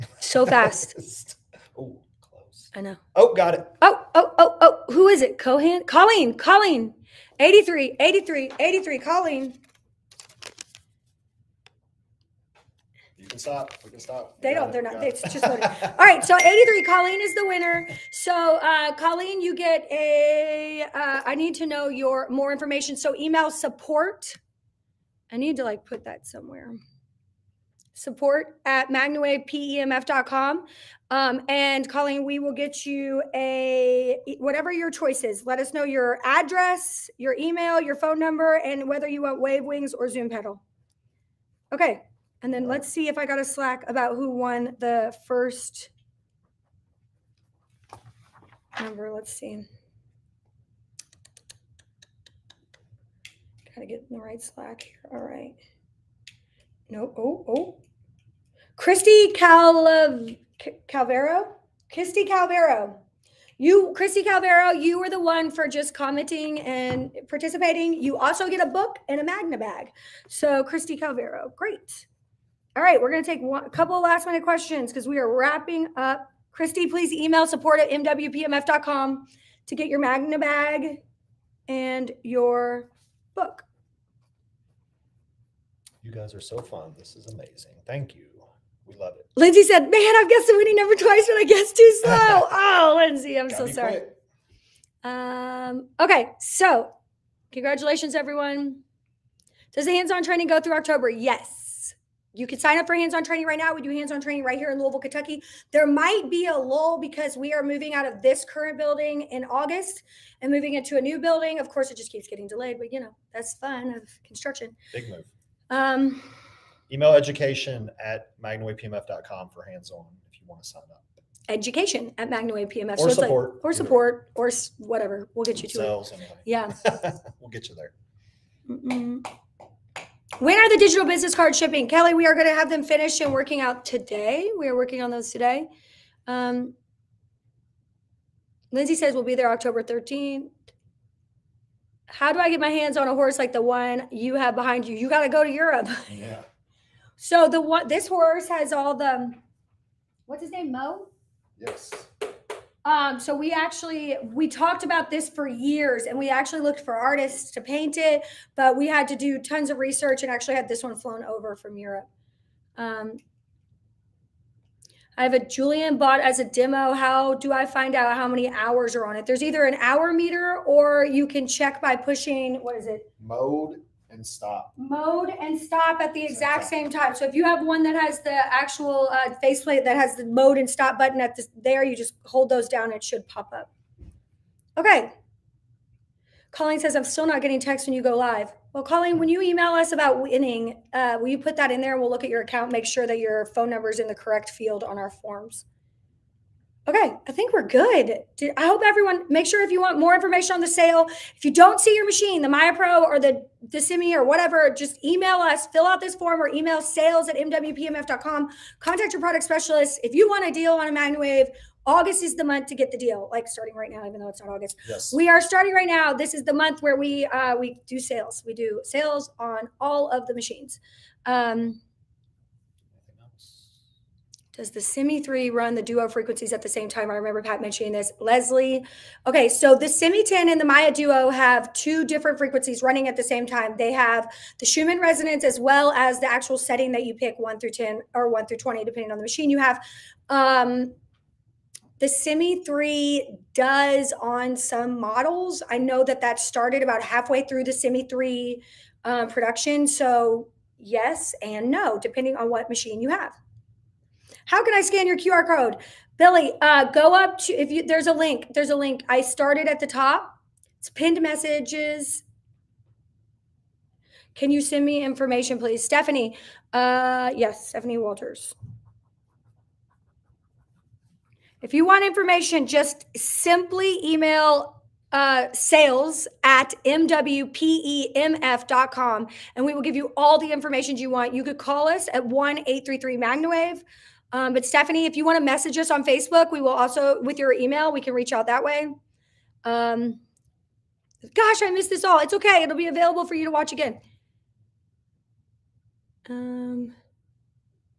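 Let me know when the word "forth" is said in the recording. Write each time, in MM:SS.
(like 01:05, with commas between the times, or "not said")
not said.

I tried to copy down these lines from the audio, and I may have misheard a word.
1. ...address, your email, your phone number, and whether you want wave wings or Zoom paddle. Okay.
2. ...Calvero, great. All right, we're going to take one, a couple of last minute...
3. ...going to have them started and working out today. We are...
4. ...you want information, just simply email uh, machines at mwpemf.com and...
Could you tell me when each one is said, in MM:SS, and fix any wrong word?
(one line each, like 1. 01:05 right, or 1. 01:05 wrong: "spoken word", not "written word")
1. 00:36 right
2. 01:10 right
3. 02:12 wrong: "finished", not "started"
4. 04:31 wrong: "sales", not "machines".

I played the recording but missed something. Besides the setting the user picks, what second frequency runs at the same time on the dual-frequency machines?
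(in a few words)
Schumann resonance.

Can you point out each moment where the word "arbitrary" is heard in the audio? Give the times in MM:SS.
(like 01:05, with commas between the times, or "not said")
not said.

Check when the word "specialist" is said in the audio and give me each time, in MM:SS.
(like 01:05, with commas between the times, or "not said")
03:29.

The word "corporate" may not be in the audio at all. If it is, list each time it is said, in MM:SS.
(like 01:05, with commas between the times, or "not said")
not said.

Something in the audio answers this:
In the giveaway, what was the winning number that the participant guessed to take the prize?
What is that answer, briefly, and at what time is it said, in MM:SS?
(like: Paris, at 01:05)
83, at 00:16.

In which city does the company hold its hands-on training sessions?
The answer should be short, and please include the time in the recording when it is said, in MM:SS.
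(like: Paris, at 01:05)
Louisville, Kentucky, at 01:44.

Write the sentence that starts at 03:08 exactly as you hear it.
Well, Colleen, when you email us about winning, uh, will you put that in there?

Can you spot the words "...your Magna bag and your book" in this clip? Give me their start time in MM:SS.
01:19.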